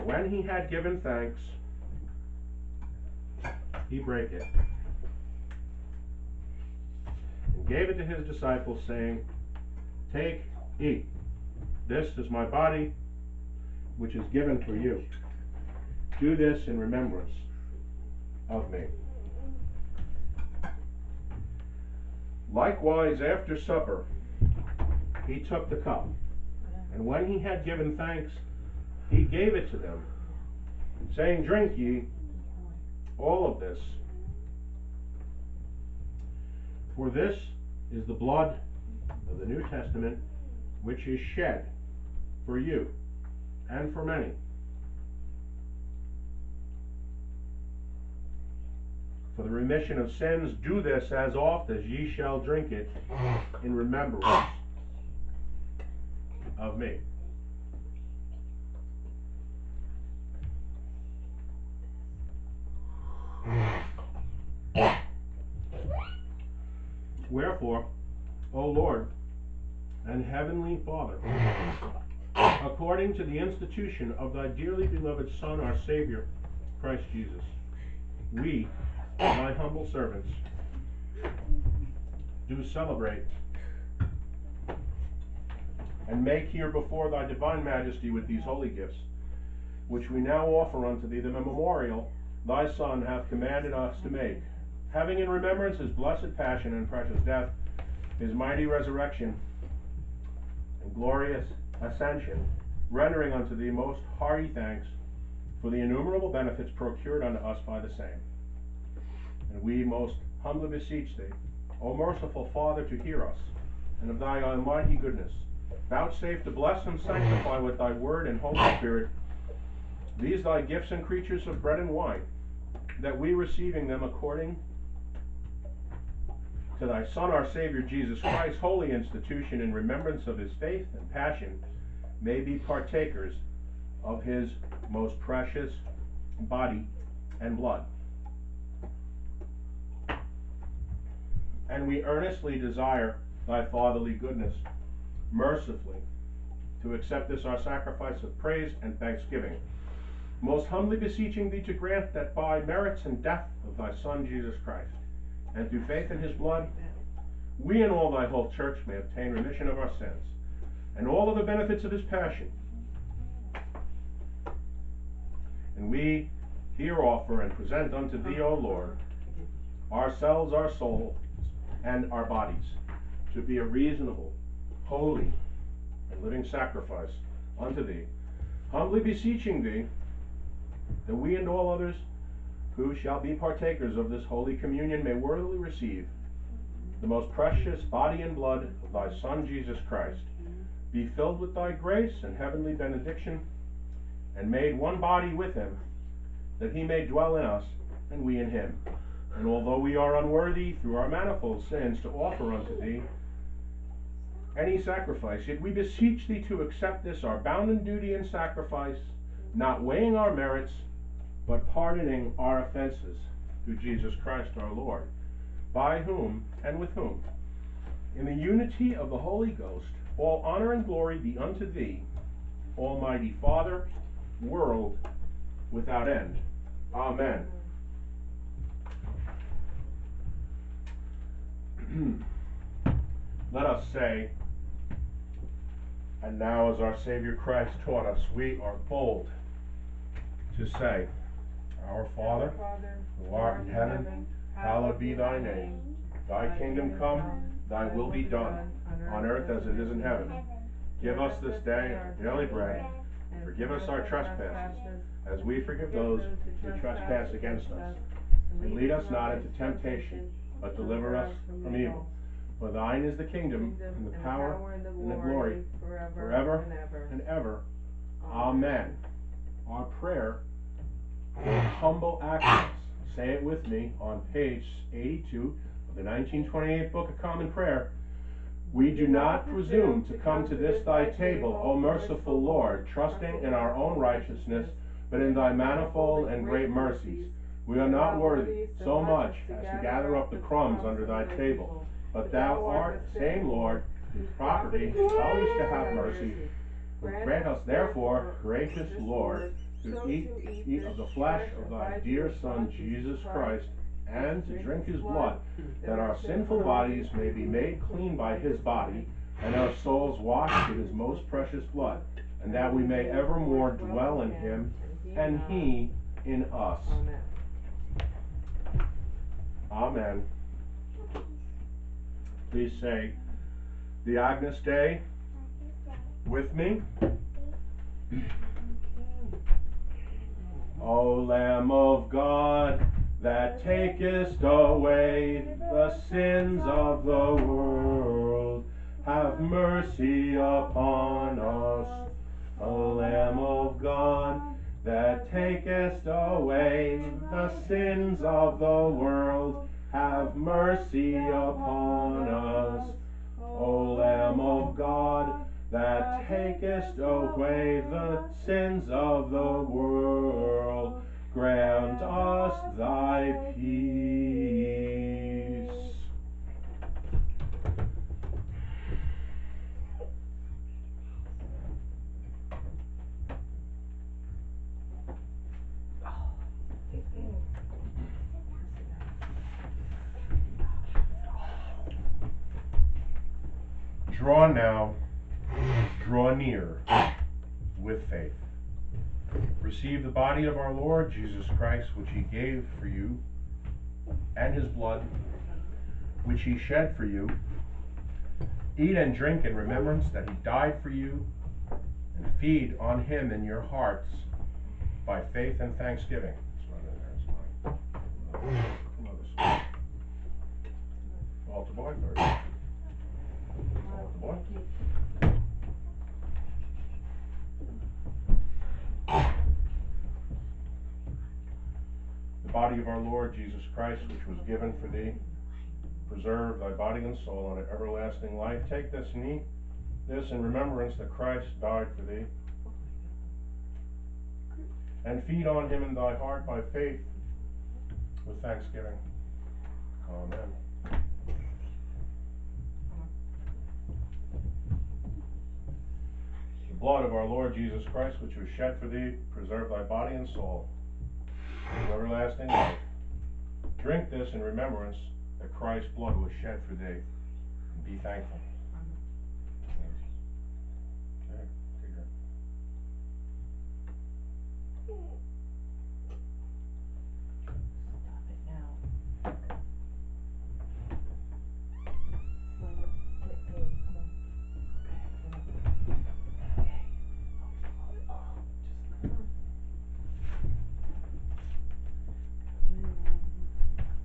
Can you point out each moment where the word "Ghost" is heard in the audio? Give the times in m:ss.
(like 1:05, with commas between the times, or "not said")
3:39.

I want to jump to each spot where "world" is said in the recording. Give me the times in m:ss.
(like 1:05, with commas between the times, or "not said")
3:44, 5:37, 5:48, 5:59.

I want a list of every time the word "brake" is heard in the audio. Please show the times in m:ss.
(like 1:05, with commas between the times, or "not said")
0:03.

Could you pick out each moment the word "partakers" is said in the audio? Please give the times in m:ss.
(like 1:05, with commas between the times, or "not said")
2:12, 3:03.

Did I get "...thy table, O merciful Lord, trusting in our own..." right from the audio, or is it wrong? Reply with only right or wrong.
right.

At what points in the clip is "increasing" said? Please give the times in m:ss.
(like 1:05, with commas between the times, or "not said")
not said.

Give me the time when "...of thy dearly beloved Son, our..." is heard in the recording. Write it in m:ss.
1:14.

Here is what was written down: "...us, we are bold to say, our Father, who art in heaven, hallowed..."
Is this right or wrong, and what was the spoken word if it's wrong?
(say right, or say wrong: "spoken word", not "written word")
right.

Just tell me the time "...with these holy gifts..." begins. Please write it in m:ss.
1:28.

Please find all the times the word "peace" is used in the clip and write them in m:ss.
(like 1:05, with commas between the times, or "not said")
6:03.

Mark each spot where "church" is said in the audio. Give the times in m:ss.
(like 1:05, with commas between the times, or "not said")
2:38.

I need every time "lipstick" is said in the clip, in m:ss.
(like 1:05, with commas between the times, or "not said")
not said.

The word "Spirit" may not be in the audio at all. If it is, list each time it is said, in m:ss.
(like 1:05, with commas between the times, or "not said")
1:58.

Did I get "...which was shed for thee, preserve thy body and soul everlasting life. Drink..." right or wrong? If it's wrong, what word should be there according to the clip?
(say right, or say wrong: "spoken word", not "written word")
right.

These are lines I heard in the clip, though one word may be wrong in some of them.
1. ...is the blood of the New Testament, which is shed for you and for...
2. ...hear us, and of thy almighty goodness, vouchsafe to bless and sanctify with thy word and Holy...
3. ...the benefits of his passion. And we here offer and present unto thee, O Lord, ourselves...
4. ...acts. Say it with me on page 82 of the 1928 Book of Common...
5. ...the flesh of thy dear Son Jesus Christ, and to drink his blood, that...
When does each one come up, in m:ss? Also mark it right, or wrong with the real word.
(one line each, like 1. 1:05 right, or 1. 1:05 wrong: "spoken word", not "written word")
1. 0:37 right
2. 1:52 right
3. 2:41 right
4. 4:32 right
5. 5:00 right.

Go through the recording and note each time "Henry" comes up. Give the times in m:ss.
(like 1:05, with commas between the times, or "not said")
not said.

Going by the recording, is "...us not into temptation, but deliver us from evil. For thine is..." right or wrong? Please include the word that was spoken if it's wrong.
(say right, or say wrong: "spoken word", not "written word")
right.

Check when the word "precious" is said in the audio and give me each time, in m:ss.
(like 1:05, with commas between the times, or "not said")
1:36, 2:15, 3:07, 5:11.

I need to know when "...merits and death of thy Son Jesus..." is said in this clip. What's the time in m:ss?
2:32.